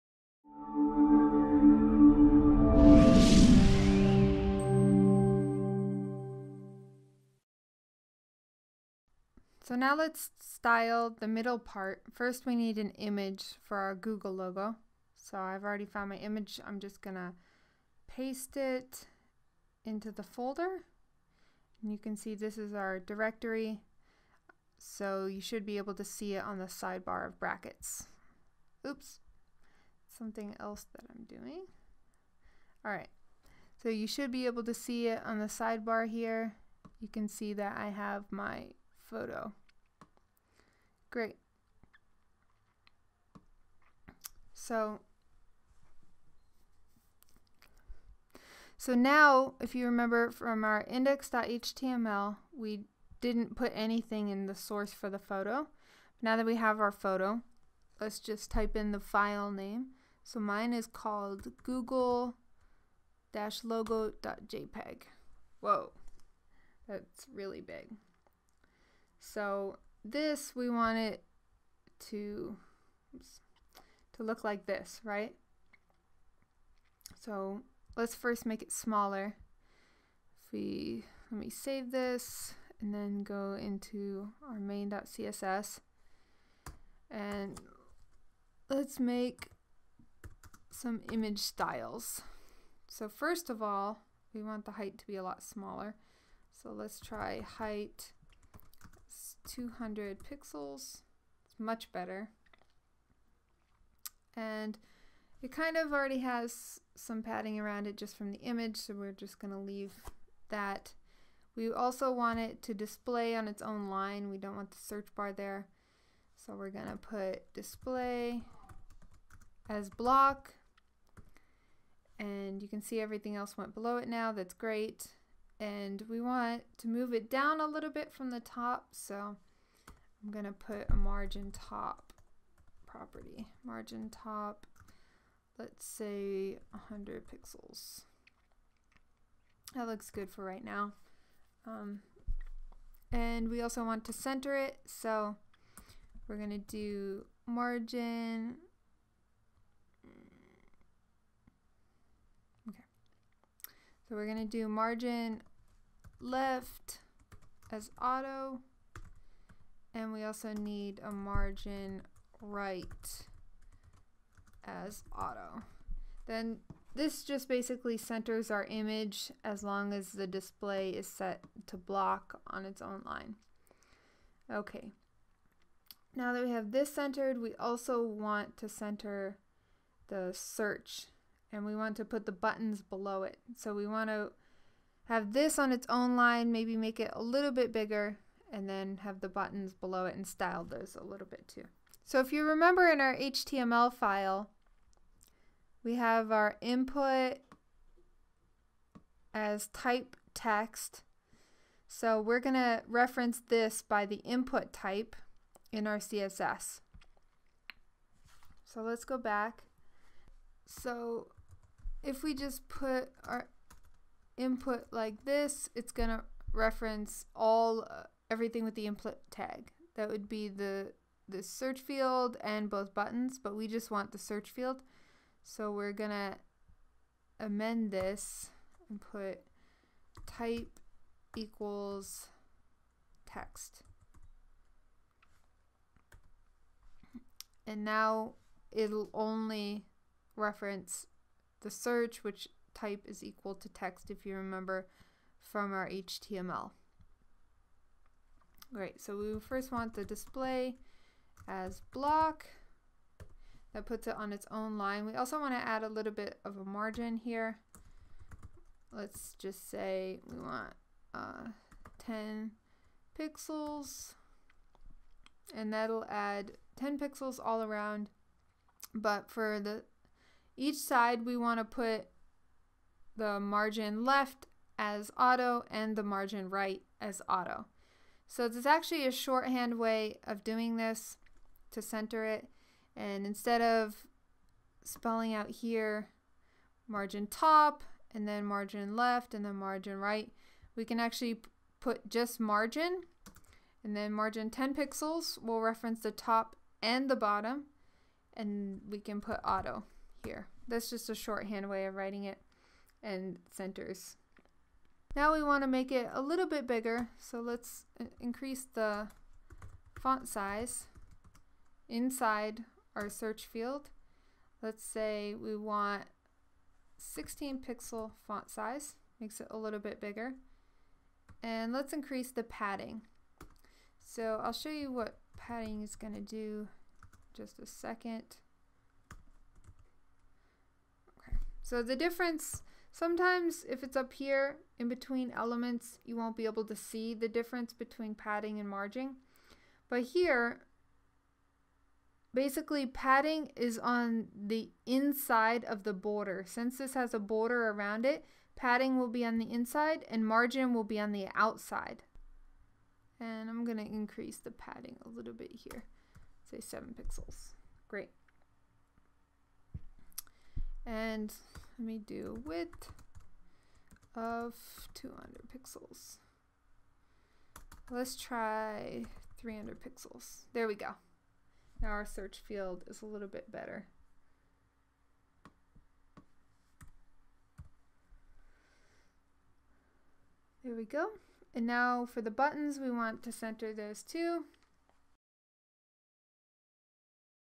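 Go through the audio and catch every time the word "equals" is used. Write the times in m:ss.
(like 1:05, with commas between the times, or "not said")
3:51, 4:03.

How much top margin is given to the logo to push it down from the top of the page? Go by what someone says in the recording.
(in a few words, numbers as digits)
100 pixels.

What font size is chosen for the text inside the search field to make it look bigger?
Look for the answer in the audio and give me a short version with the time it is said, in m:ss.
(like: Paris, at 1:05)
16 pixels, at 5:16.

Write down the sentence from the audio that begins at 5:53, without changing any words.
And I'm going to increase the padding a little bit here, say 7 pixels.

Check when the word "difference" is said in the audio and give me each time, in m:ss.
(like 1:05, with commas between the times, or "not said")
5:31, 5:37.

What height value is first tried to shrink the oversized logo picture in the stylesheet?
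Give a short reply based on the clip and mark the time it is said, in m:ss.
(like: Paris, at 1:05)
200 pixels, at 1:37.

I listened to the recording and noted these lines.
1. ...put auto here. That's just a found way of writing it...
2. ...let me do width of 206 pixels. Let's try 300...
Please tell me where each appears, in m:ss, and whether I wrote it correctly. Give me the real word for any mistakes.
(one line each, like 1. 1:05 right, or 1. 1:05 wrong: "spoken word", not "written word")
1. 4:59 wrong: "shorthand", not "found"
2. 6:01 wrong: "200", not "206".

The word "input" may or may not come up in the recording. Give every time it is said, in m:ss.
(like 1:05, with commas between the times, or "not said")
3:16, 3:24, 3:34, 3:38.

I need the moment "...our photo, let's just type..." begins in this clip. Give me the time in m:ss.
0:56.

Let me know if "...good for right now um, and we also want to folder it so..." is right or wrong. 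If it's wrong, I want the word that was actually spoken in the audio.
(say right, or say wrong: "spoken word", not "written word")
wrong: "center", not "folder".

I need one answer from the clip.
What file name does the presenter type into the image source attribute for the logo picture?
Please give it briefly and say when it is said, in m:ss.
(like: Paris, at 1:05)
google-logo.jpg, at 1:01.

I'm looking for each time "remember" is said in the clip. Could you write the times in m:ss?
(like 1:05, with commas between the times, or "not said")
0:49, 3:12, 4:04.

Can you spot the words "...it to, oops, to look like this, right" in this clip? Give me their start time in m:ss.
1:10.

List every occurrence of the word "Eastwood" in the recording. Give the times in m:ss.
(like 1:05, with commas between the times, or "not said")
not said.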